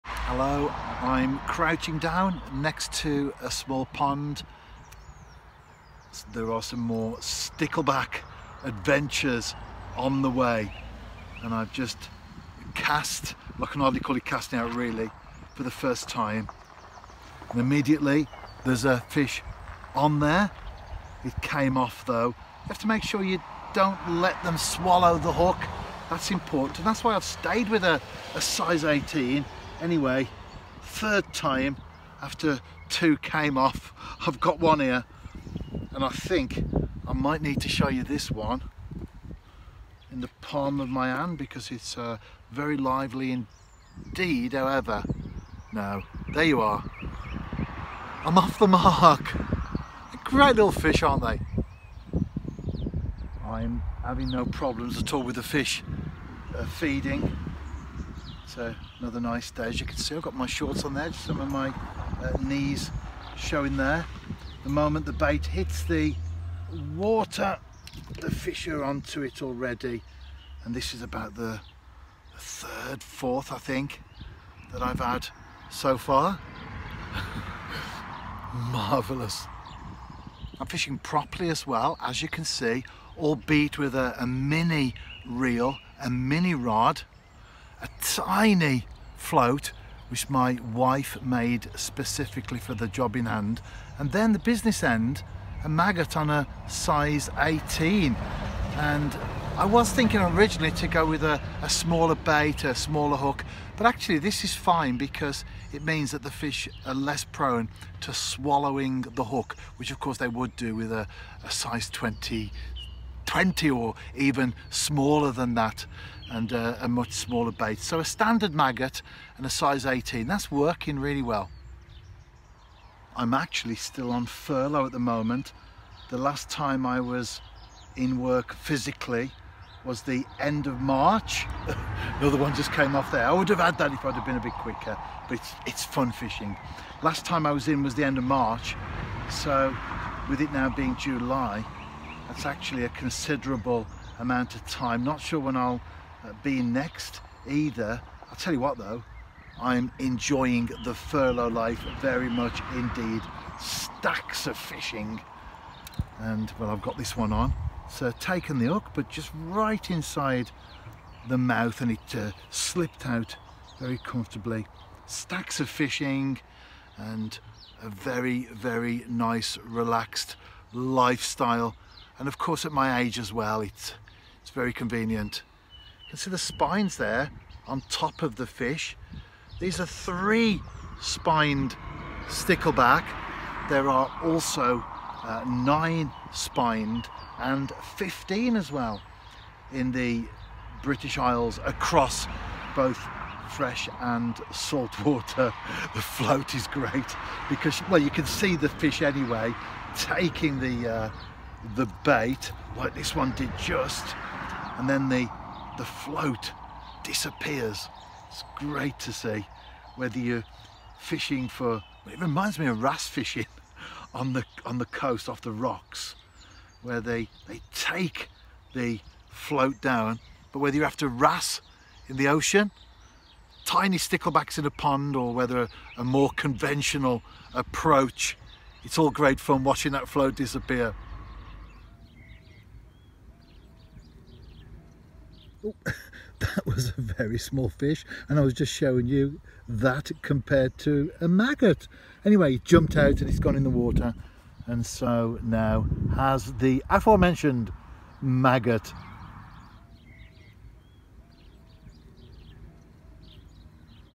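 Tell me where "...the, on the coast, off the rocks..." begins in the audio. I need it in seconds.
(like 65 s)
214 s.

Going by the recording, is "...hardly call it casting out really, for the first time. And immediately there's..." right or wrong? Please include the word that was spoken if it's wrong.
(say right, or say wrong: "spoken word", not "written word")
right.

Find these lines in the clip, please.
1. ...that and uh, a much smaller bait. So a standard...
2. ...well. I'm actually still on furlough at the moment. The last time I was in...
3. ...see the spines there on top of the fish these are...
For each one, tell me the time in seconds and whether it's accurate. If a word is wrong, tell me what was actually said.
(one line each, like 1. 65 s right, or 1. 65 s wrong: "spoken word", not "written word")
1. 115 s right
2. 121 s right
3. 176 s right.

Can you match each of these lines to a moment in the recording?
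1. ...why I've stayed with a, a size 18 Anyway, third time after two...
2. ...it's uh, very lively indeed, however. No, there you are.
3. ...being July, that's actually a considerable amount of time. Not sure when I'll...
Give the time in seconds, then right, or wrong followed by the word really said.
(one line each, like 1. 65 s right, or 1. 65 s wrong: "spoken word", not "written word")
1. 27 s right
2. 41 s right
3. 140 s right.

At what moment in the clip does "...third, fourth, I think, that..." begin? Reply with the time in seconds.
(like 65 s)
72 s.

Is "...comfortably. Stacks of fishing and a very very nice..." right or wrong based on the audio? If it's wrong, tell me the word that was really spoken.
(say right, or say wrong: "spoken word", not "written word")
right.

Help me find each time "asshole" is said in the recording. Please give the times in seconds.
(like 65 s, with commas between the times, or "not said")
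not said.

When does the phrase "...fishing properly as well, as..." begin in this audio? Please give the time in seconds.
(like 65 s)
80 s.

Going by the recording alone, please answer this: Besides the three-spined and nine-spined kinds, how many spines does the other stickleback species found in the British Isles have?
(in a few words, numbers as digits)
15.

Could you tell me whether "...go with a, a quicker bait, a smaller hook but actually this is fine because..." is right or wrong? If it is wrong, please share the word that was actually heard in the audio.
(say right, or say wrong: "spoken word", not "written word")
wrong: "smaller", not "quicker".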